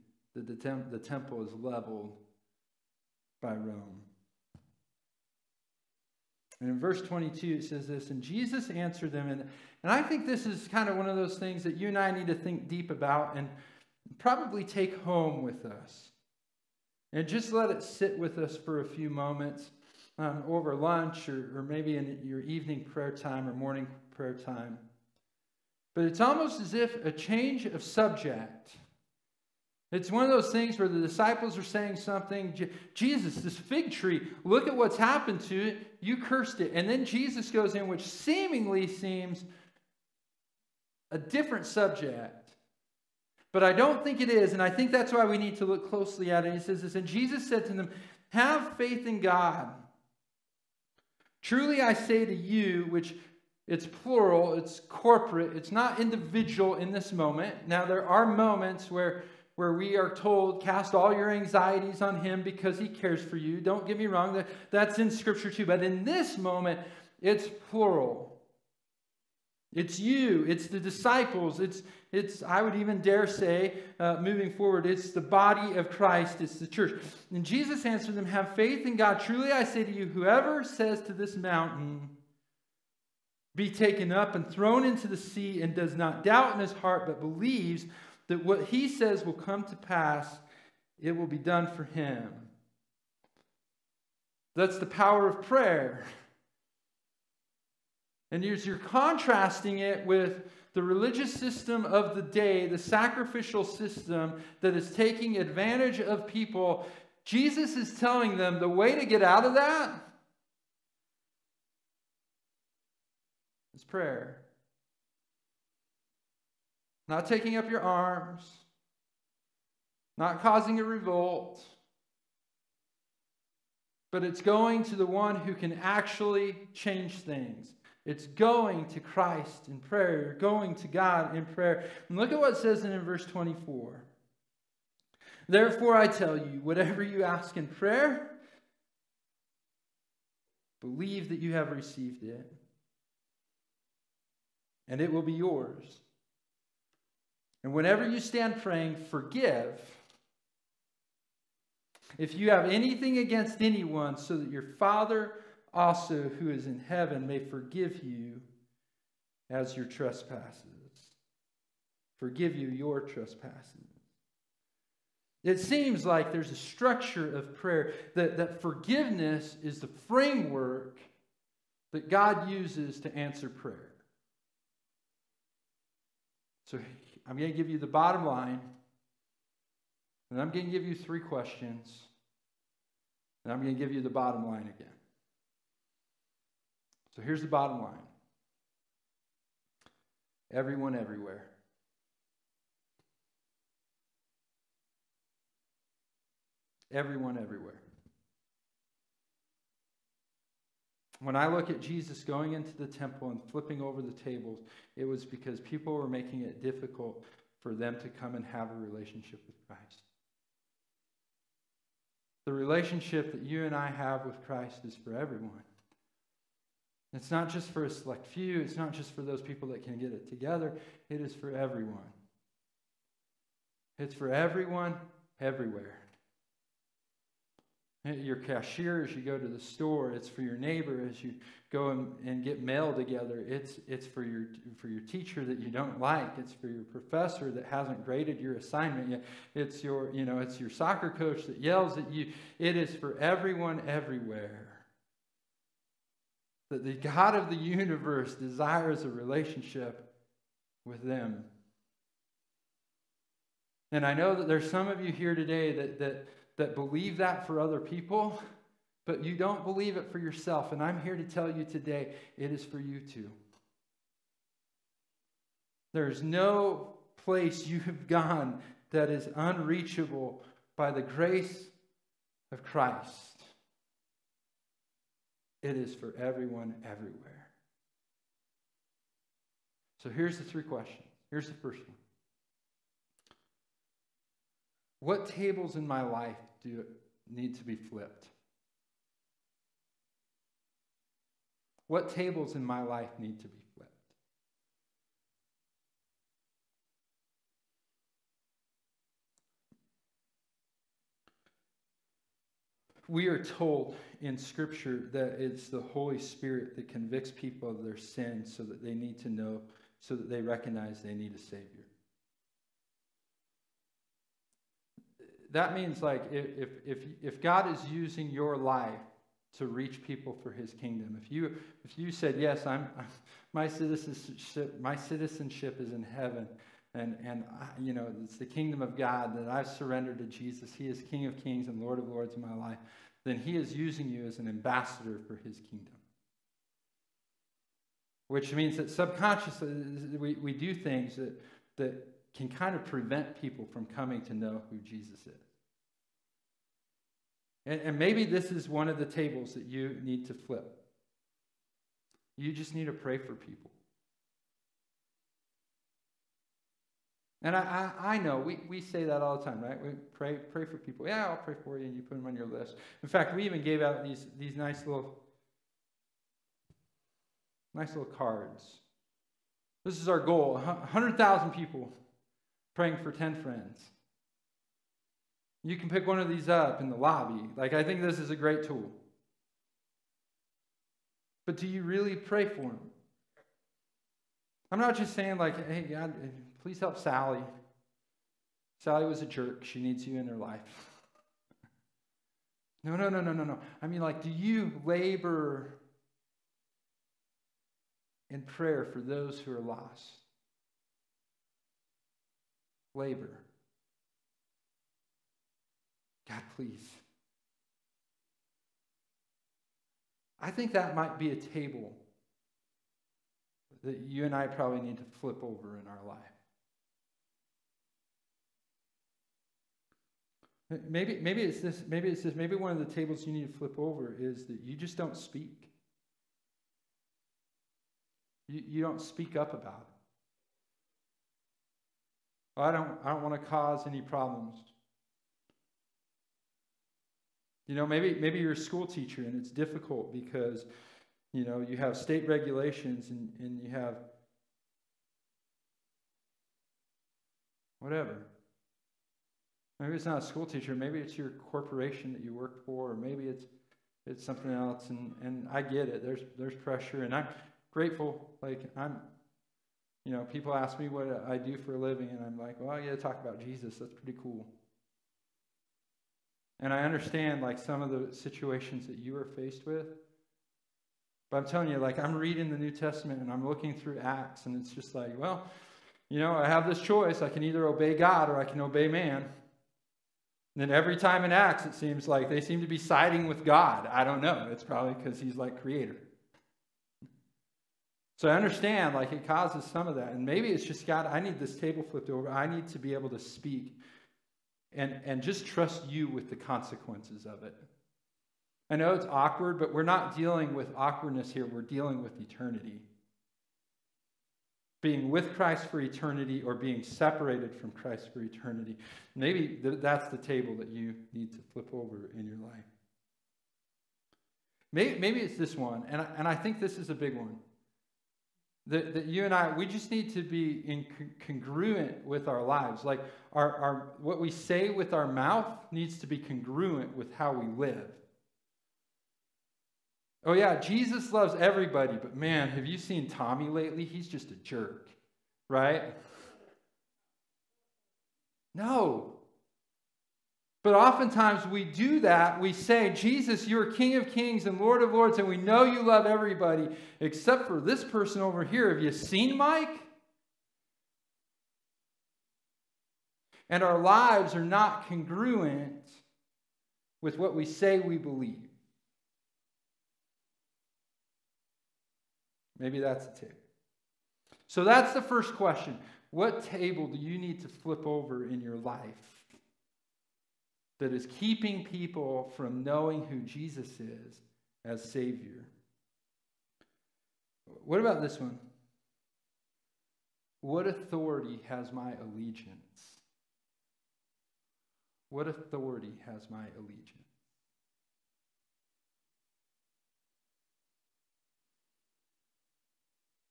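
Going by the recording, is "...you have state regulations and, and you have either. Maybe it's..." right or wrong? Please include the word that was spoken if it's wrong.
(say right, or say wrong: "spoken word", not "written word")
wrong: "whatever", not "either".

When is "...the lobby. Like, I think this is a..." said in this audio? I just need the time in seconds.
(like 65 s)
376 s.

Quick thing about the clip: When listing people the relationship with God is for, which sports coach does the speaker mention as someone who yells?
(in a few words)
soccer coach.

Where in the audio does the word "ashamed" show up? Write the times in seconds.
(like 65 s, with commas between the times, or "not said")
not said.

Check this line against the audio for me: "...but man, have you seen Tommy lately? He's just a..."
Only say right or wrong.
right.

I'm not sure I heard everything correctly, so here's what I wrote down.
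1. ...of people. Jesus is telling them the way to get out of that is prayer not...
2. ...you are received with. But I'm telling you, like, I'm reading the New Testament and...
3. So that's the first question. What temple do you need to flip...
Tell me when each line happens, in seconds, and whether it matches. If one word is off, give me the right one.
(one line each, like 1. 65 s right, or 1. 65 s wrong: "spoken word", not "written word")
1. 105 s right
2. 468 s wrong: "faced", not "received"
3. 564 s wrong: "table", not "temple".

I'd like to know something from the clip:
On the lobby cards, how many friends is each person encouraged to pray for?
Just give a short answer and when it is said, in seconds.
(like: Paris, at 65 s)
10, at 373 s.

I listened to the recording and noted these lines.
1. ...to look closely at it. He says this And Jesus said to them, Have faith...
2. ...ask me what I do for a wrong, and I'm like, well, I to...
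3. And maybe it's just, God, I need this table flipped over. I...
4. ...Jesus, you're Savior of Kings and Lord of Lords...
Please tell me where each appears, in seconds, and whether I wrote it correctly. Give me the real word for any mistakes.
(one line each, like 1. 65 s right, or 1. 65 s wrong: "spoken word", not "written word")
1. 45 s right
2. 460 s wrong: "living", not "wrong"
3. 490 s right
4. 542 s wrong: "King", not "Savior".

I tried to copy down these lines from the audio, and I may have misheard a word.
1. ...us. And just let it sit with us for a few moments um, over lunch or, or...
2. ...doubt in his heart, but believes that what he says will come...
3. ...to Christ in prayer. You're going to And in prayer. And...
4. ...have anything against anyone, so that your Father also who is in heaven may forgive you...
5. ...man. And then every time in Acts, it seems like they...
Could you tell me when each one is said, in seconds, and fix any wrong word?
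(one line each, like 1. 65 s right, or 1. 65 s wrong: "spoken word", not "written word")
1. 15 s right
2. 86 s right
3. 128 s wrong: "God", not "And"
4. 152 s right
5. 478 s right.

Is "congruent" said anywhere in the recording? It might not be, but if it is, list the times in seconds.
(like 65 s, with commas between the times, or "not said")
521 s, 526 s, 554 s.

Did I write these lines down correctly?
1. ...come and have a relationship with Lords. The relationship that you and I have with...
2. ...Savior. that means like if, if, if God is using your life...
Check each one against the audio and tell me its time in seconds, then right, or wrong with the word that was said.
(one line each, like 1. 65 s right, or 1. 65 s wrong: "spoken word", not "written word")
1. 208 s wrong: "Christ", not "Lords"
2. 311 s right.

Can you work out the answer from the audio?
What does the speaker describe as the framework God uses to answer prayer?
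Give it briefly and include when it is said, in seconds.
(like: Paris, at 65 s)
forgiveness, at 168 s.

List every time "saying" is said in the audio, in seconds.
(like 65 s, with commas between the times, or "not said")
31 s, 385 s.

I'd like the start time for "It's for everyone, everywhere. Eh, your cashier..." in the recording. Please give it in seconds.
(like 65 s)
223 s.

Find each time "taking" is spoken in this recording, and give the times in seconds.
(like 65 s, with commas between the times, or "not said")
104 s, 117 s.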